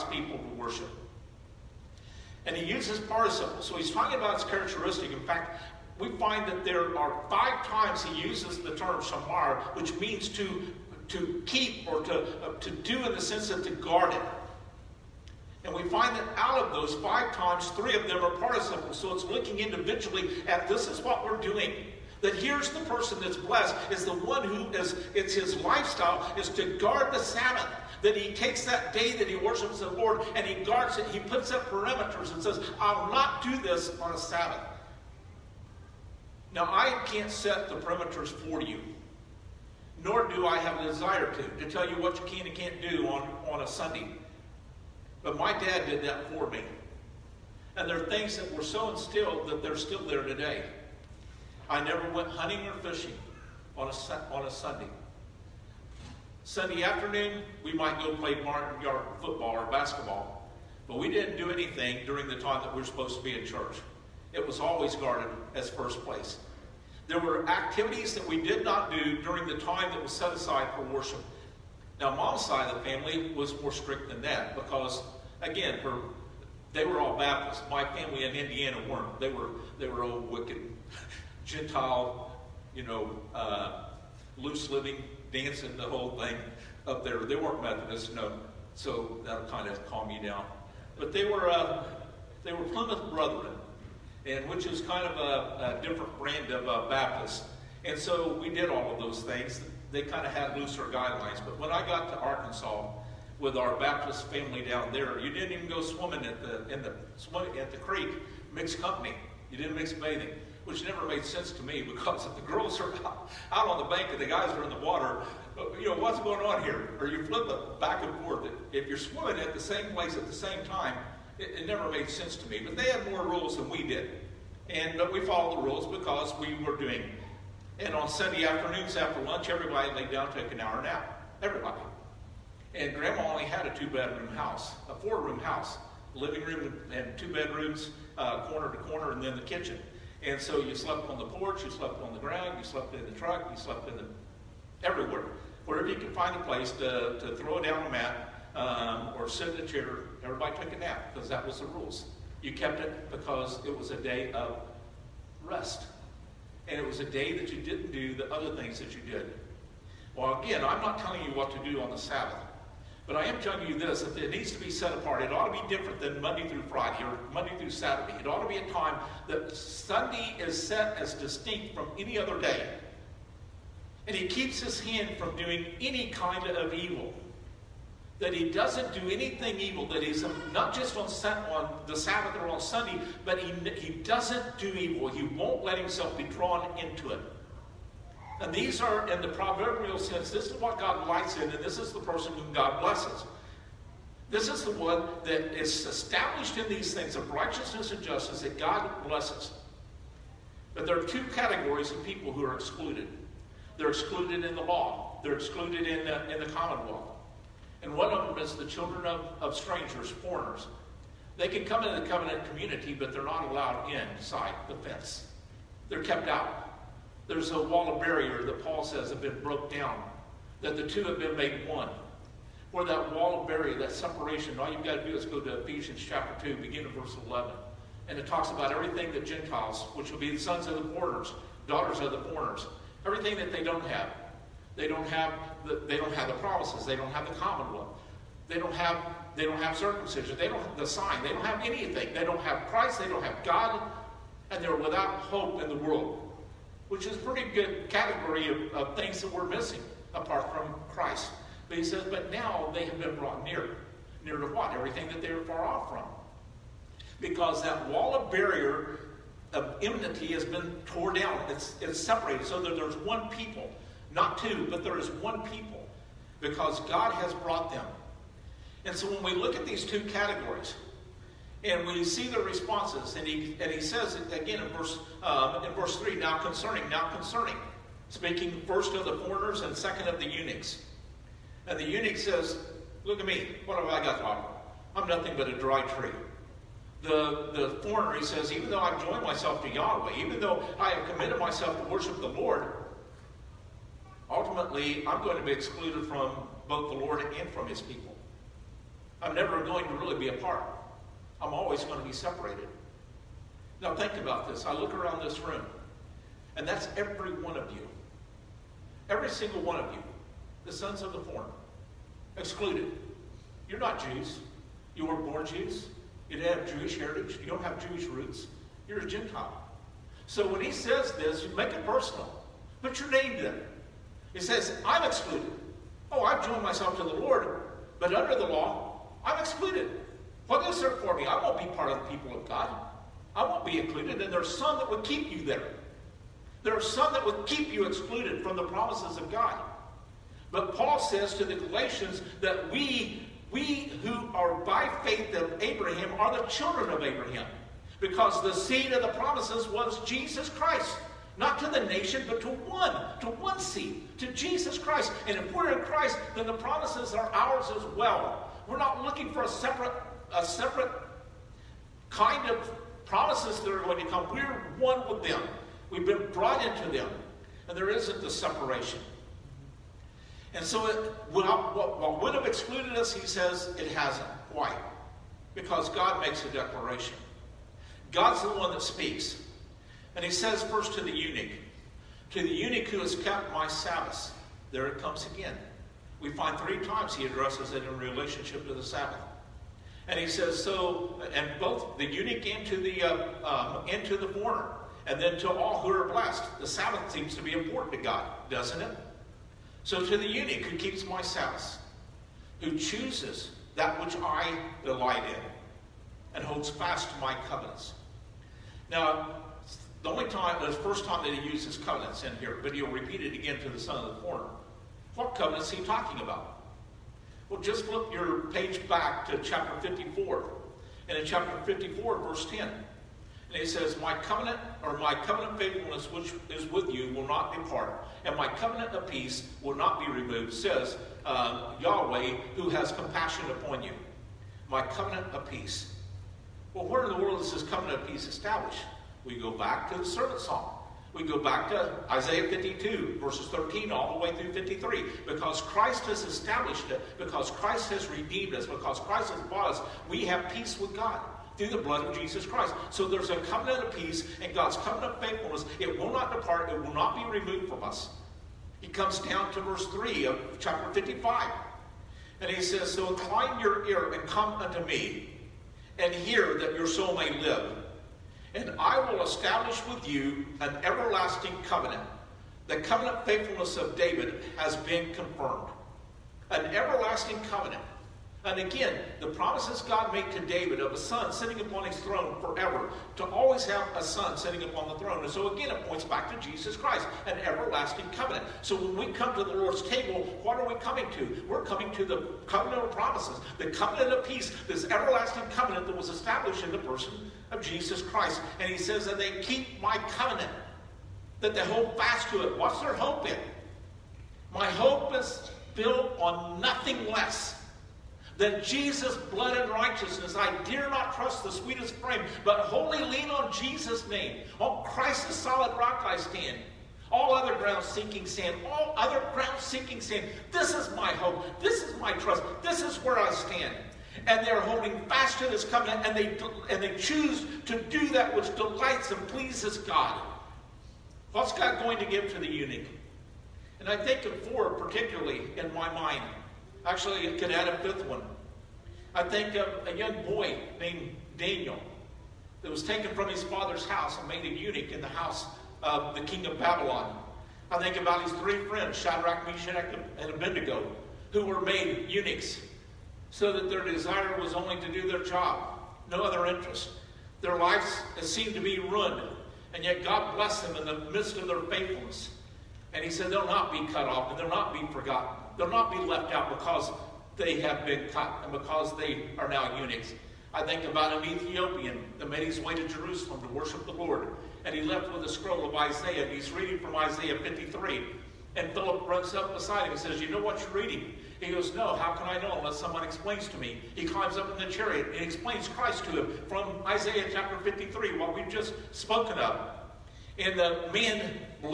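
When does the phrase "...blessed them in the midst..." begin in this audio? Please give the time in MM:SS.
09:20.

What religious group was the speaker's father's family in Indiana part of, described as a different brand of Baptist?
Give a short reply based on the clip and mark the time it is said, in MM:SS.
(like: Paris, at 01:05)
Plymouth Brethren, at 01:32.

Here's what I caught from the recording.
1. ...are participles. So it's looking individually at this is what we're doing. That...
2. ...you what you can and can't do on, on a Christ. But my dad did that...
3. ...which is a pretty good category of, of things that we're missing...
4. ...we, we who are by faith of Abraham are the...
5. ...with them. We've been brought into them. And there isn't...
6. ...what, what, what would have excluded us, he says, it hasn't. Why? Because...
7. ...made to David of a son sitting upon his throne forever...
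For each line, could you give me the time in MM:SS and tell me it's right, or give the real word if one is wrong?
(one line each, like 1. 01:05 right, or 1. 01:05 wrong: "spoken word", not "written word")
1. 00:18 right
2. 00:41 wrong: "Sunday", not "Christ"
3. 04:06 right
4. 05:42 right
5. 06:05 right
6. 06:11 right
7. 08:00 right.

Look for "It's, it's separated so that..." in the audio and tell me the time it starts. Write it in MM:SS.
04:21.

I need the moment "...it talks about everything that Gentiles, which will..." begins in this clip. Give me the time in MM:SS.
03:48.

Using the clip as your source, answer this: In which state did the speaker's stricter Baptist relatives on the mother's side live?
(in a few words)
Arkansas.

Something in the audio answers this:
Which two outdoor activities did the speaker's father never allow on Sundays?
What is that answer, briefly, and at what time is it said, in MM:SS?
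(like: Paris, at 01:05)
hunting or fishing, at 00:52.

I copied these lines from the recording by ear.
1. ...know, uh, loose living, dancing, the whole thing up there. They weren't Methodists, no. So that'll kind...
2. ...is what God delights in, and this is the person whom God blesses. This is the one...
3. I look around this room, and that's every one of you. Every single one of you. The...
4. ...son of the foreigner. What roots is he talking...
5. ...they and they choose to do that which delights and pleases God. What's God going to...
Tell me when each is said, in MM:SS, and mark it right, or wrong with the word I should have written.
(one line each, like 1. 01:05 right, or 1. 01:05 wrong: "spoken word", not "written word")
1. 01:22 right
2. 03:10 right
3. 05:04 right
4. 06:53 wrong: "covenants", not "roots"
5. 08:46 right.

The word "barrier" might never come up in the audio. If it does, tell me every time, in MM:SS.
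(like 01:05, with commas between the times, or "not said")
03:38, 03:43, 04:18.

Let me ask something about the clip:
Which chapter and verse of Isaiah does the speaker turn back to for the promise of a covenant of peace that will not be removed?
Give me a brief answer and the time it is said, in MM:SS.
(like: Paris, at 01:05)
Chapter 54, verse 10, at 07:01.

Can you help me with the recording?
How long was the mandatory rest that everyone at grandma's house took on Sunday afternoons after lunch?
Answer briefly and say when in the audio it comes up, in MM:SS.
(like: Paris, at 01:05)
an hour, at 02:10.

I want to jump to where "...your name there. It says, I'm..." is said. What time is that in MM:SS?
05:22.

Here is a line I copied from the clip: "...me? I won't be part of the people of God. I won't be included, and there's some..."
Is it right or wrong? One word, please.
right.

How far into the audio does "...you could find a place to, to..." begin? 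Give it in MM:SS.
02:25.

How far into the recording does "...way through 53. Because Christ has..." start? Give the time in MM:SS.
07:24.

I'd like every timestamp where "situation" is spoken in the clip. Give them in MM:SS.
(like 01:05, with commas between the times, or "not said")
not said.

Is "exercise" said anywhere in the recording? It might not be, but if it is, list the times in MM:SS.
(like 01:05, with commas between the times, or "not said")
not said.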